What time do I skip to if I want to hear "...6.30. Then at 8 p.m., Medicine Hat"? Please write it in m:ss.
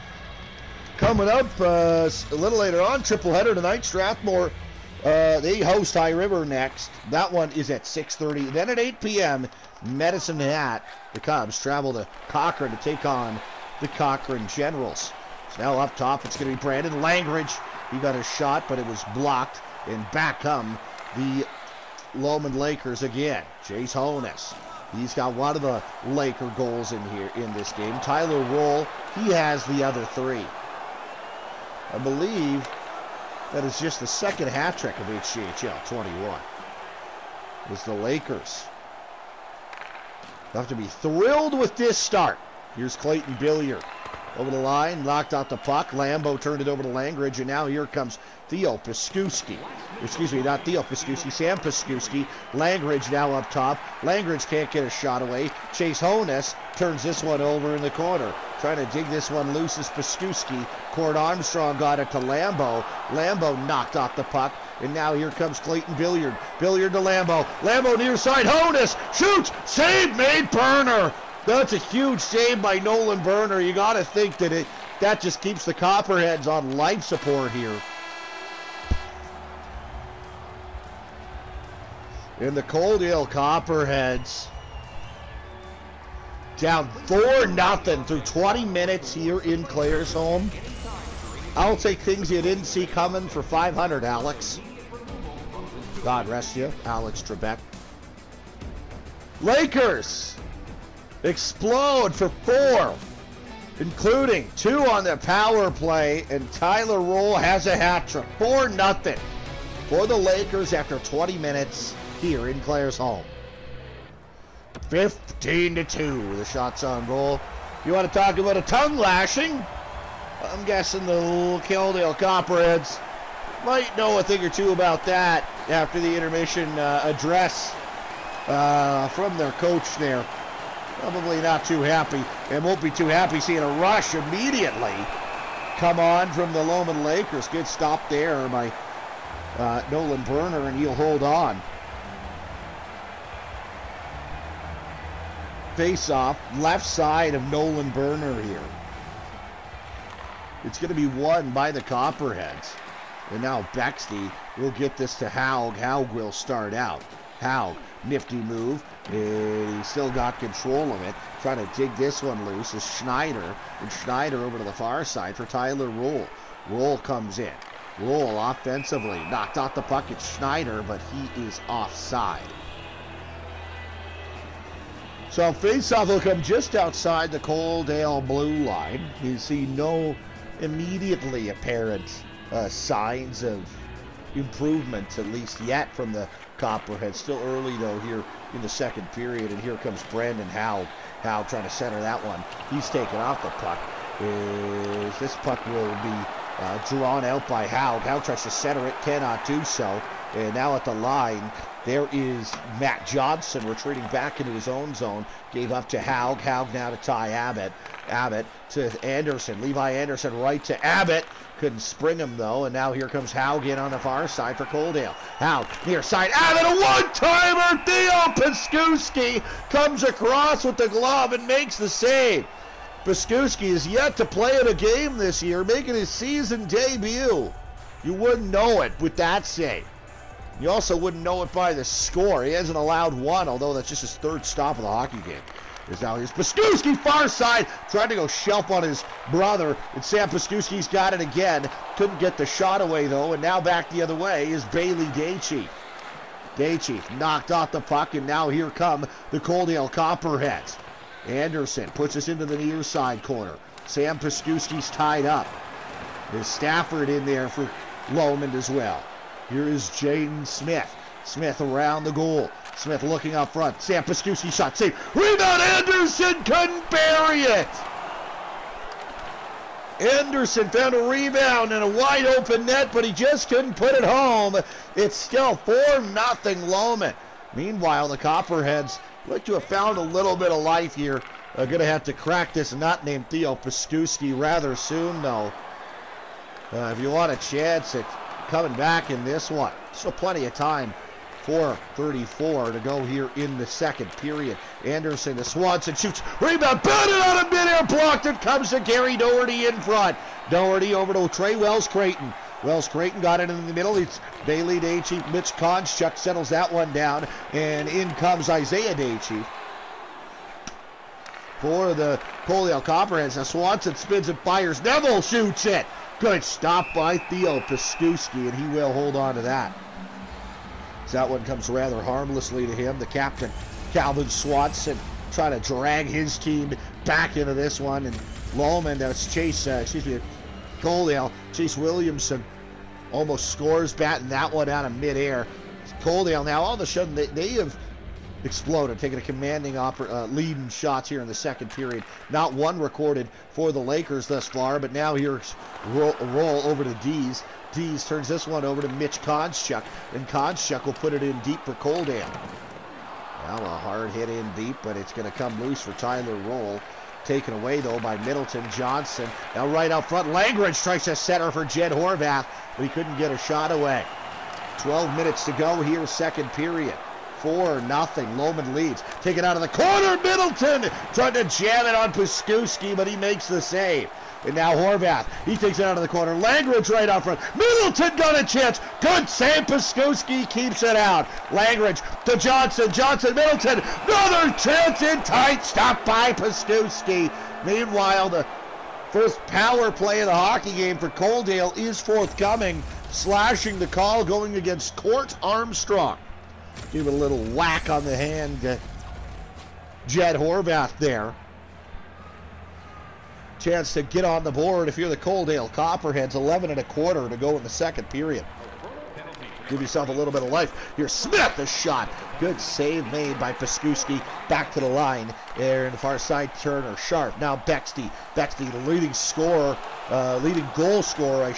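0:07.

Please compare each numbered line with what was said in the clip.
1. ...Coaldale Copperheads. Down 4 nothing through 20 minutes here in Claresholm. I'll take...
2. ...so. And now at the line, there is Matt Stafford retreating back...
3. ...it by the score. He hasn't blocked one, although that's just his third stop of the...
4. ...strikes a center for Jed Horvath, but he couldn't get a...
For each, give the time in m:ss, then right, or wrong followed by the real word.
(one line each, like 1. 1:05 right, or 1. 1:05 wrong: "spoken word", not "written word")
1. 1:22 right
2. 3:19 wrong: "Johnson", not "Stafford"
3. 3:51 wrong: "allowed", not "blocked"
4. 6:00 right.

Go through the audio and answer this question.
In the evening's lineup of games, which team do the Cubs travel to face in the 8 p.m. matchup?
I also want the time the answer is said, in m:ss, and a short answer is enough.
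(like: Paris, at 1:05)
Cochrane Generals, at 0:13.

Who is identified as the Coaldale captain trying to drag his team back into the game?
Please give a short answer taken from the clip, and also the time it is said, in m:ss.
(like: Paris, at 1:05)
Calvin Swanson, at 5:23.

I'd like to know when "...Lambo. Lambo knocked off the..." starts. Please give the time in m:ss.
1:02.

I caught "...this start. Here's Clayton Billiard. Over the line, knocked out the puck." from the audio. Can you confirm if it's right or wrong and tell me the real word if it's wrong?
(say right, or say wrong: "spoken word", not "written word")
right.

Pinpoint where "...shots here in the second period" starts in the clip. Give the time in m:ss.
5:40.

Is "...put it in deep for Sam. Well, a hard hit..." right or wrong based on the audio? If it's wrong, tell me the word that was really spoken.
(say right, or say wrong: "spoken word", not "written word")
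wrong: "Coldam", not "Sam".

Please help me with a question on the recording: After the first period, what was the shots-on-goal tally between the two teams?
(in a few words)
15 to 2.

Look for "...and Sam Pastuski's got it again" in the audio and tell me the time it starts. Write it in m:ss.
3:59.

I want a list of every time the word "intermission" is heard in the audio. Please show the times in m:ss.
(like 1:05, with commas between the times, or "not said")
2:06.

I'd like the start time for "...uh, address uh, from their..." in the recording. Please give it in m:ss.
2:06.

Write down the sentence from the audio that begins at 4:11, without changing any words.
Anderson puts us into the near side corner.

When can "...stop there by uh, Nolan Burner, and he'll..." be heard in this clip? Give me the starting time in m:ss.
2:17.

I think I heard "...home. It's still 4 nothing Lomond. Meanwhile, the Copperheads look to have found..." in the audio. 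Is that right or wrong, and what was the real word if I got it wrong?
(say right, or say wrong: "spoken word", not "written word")
right.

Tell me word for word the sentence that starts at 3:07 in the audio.
Still early, though, here in the second period.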